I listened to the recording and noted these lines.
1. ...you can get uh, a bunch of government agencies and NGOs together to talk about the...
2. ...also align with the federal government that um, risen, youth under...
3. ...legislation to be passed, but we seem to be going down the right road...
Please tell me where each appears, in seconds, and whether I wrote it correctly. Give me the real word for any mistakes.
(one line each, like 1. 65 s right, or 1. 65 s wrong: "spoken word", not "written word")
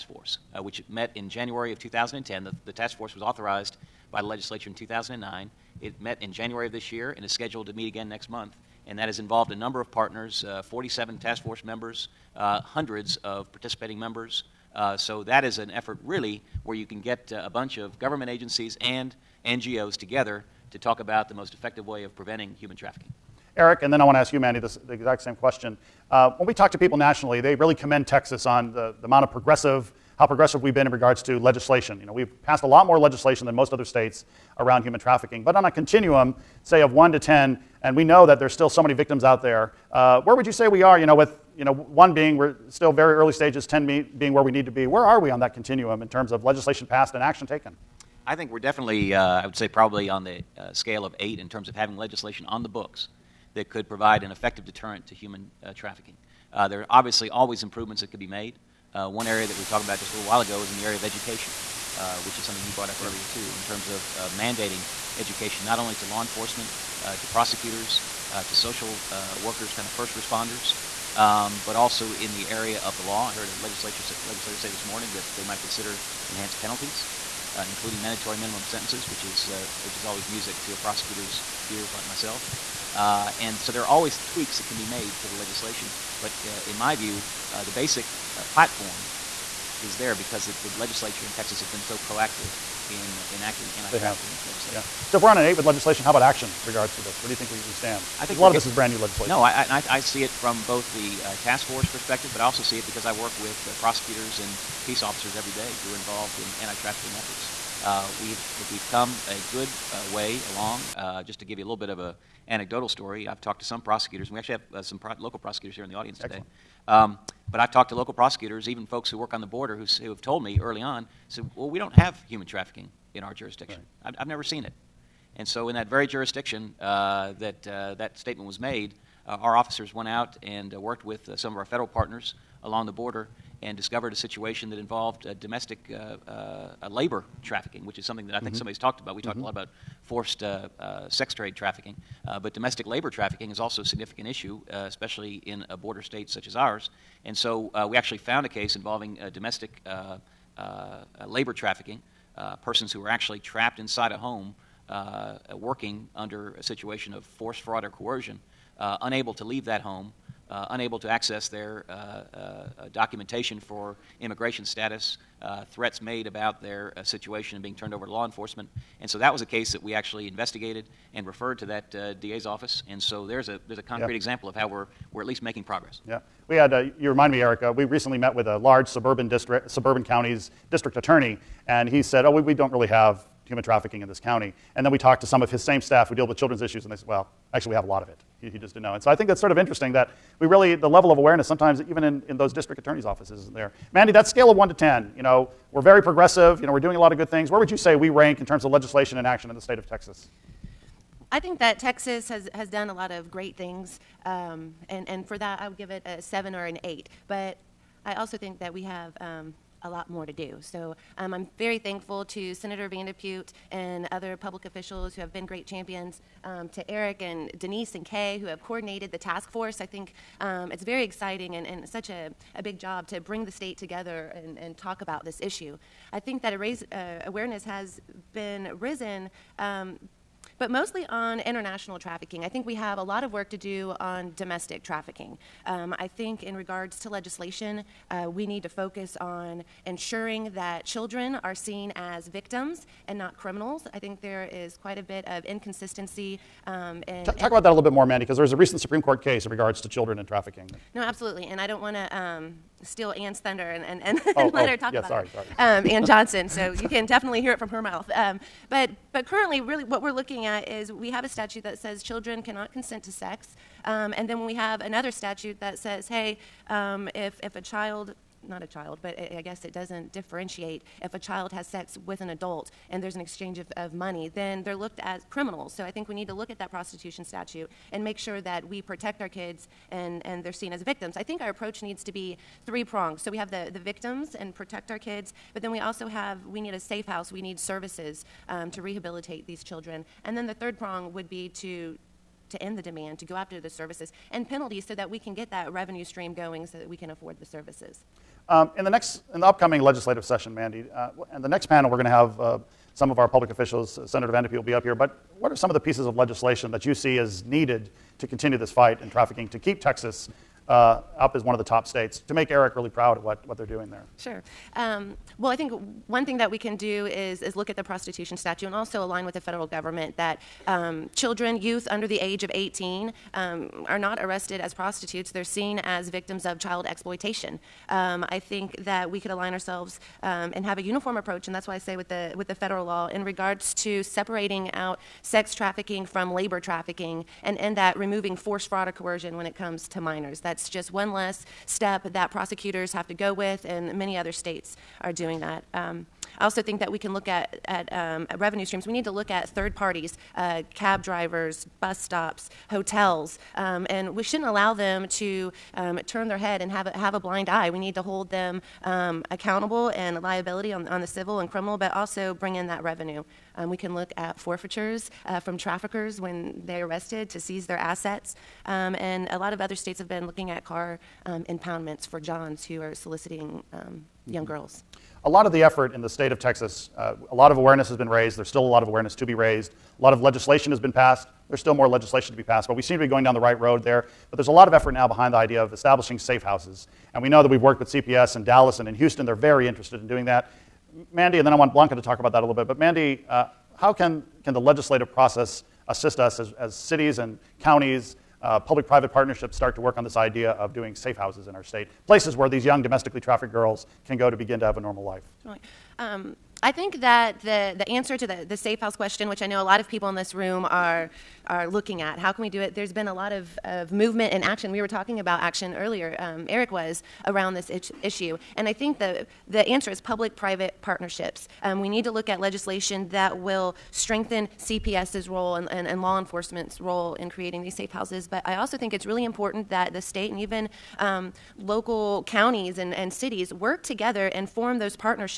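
1. 16 s right
2. 318 s wrong: "children", not "risen"
3. 381 s right.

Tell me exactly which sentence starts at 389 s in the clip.
They're very interested in doing that.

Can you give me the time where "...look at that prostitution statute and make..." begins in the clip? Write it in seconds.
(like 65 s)
276 s.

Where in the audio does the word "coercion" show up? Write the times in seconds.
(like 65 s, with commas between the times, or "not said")
157 s, 338 s.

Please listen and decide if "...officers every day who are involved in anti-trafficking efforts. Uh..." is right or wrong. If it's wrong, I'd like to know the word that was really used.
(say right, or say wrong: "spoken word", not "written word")
right.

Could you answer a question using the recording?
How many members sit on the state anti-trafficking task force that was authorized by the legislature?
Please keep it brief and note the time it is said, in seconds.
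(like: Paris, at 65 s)
47, at 10 s.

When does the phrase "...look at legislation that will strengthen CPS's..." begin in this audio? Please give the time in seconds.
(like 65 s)
422 s.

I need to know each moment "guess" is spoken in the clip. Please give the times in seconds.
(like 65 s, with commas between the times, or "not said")
269 s.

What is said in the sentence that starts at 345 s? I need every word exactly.
Um, I also think that we can look at, at, um, at revenue streams.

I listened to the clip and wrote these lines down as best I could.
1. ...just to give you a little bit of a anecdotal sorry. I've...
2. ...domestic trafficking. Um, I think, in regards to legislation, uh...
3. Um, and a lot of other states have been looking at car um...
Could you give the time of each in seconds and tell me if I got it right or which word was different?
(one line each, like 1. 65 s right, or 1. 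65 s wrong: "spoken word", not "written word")
1. 111 s wrong: "story", not "sorry"
2. 234 s right
3. 368 s right.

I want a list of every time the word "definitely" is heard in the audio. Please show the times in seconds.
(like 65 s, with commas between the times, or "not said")
48 s, 257 s.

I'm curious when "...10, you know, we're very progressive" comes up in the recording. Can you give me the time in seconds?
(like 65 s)
194 s.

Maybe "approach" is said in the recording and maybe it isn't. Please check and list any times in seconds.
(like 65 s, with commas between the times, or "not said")
281 s, 331 s.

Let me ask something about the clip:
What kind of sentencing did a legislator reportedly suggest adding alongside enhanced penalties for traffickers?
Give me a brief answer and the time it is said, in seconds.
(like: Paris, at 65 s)
mandatory minimum sentences, at 78 s.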